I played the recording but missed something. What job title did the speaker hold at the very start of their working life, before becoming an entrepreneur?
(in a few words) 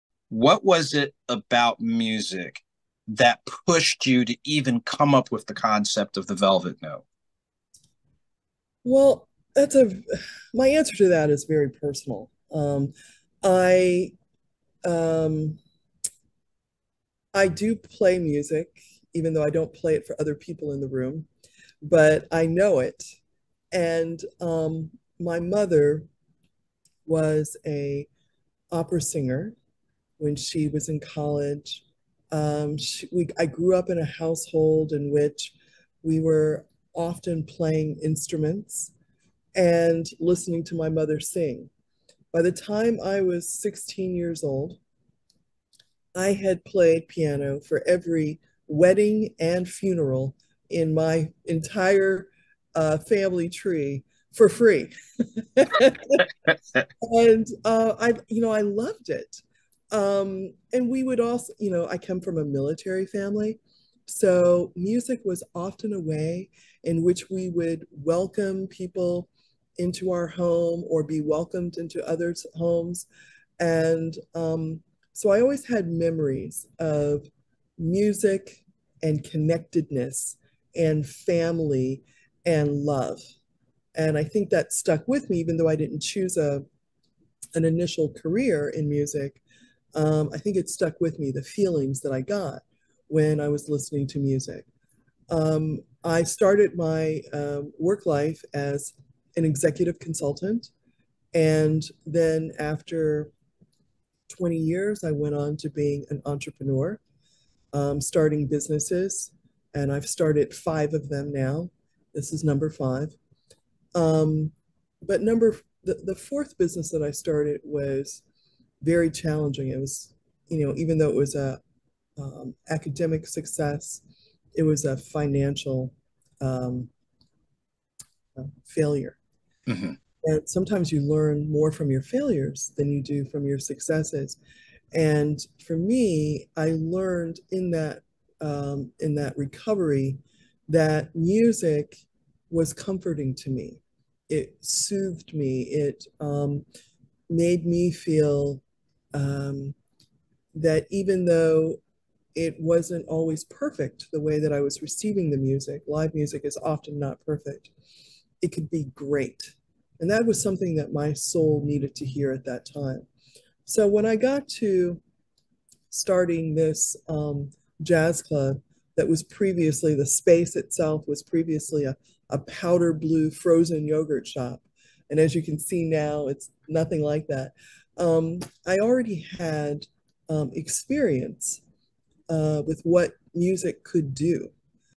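executive consultant.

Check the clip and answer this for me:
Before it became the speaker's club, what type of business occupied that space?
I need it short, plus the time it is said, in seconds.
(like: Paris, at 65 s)
frozen yogurt shop, at 173 s.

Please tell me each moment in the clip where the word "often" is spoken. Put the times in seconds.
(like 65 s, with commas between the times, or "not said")
36 s, 65 s, 156 s.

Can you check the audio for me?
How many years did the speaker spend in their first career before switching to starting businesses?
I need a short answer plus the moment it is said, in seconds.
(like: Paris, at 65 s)
20, at 104 s.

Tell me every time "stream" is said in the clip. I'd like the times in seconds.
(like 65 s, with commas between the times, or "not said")
not said.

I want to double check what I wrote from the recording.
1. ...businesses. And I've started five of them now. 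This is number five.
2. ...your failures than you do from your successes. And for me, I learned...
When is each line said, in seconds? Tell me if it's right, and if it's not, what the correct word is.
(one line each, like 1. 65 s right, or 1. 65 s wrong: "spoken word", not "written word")
1. 108 s right
2. 131 s right.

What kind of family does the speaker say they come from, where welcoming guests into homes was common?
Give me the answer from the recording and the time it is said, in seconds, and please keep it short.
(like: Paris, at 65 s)
military, at 62 s.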